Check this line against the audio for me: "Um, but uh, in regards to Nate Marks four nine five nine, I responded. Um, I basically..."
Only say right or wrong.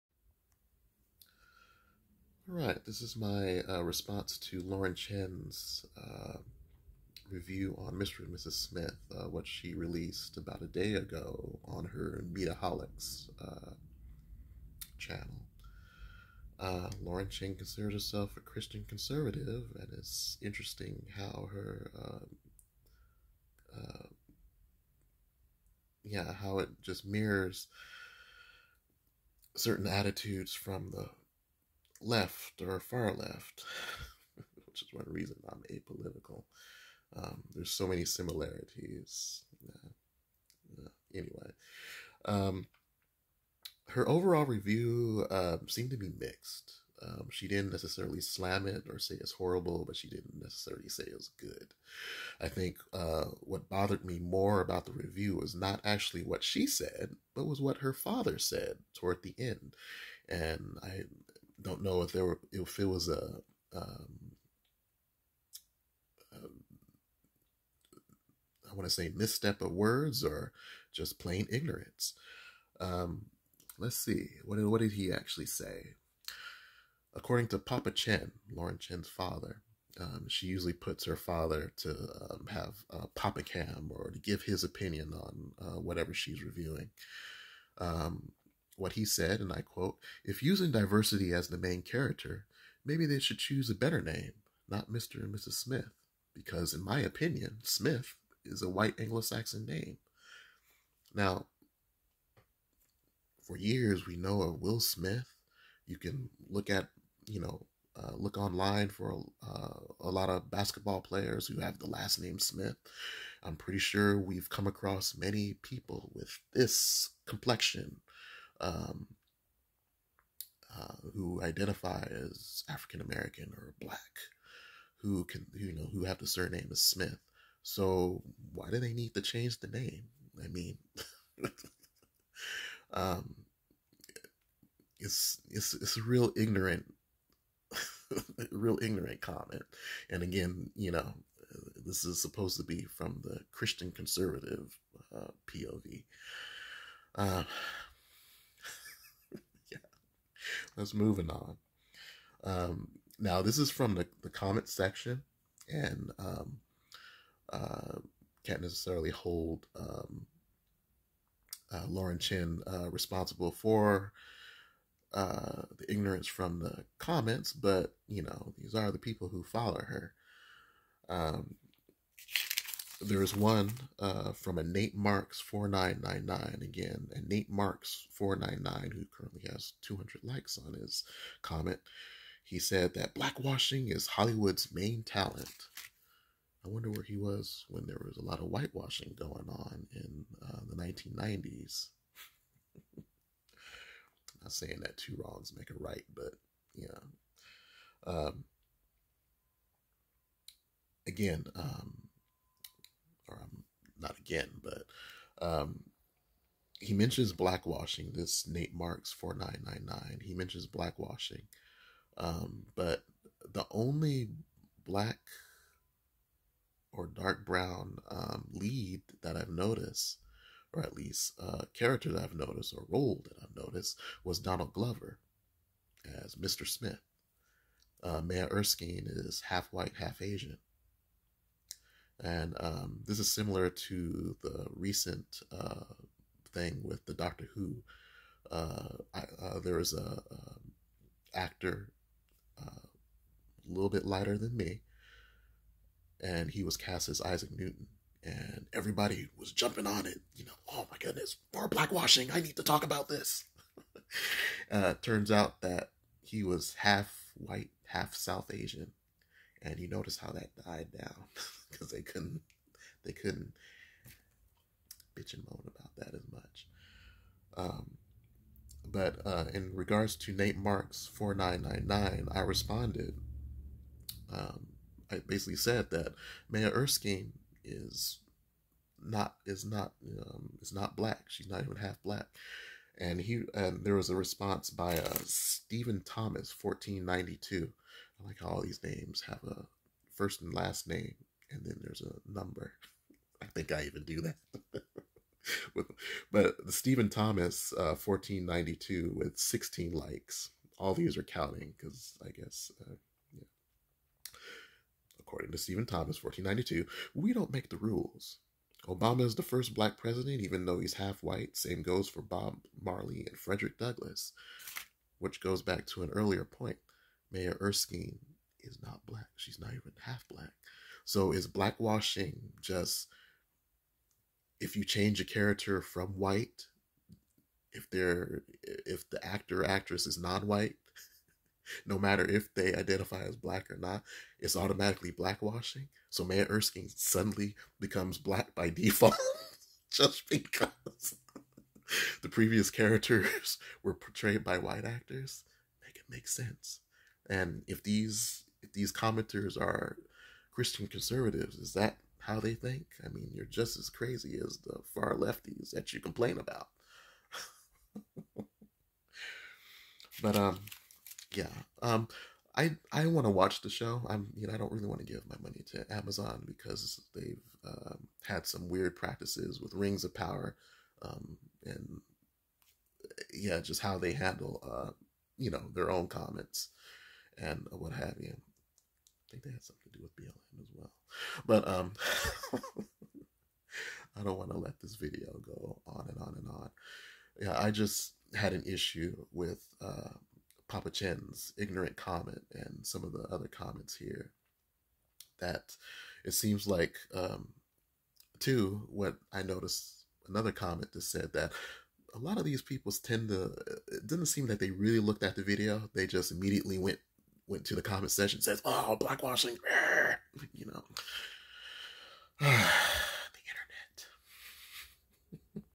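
wrong.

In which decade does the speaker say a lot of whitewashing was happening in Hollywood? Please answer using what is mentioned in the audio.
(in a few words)
1990s.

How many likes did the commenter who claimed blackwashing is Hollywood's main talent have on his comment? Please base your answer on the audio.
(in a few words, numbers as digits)
200.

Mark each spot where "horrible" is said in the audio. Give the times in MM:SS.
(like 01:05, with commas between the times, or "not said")
00:49.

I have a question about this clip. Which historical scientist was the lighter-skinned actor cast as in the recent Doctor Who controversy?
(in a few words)
Isaac Newton.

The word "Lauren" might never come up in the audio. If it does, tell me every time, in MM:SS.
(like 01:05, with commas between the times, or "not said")
00:04, 00:17, 01:18, 02:41.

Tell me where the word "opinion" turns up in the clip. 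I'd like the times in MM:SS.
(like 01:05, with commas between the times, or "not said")
01:24, 01:36.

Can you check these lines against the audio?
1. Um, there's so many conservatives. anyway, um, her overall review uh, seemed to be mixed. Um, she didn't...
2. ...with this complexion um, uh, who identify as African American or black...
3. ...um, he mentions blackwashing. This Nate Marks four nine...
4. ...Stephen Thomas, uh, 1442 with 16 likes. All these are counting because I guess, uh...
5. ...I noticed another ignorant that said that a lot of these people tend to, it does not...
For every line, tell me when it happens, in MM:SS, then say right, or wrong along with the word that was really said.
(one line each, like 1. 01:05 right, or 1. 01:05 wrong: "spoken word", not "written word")
1. 00:37 wrong: "similarities", not "conservatives"
2. 01:56 right
3. 03:25 right
4. 04:56 wrong: "1492", not "1442"
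5. 06:39 wrong: "comment", not "ignorant".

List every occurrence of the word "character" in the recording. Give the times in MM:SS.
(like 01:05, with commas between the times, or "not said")
01:31, 03:41, 05:25, 05:42.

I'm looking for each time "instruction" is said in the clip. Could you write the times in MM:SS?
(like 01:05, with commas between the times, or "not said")
not said.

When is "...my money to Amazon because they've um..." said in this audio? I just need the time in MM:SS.
06:05.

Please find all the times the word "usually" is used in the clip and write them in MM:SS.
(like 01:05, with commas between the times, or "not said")
01:20.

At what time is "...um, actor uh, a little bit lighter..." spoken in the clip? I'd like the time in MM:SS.
04:00.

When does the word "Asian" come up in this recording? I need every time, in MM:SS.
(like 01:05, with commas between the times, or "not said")
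03:50, 04:18.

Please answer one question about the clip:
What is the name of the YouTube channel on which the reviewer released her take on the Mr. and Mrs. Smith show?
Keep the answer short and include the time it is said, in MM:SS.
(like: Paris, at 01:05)
Mediaholics, at 00:12.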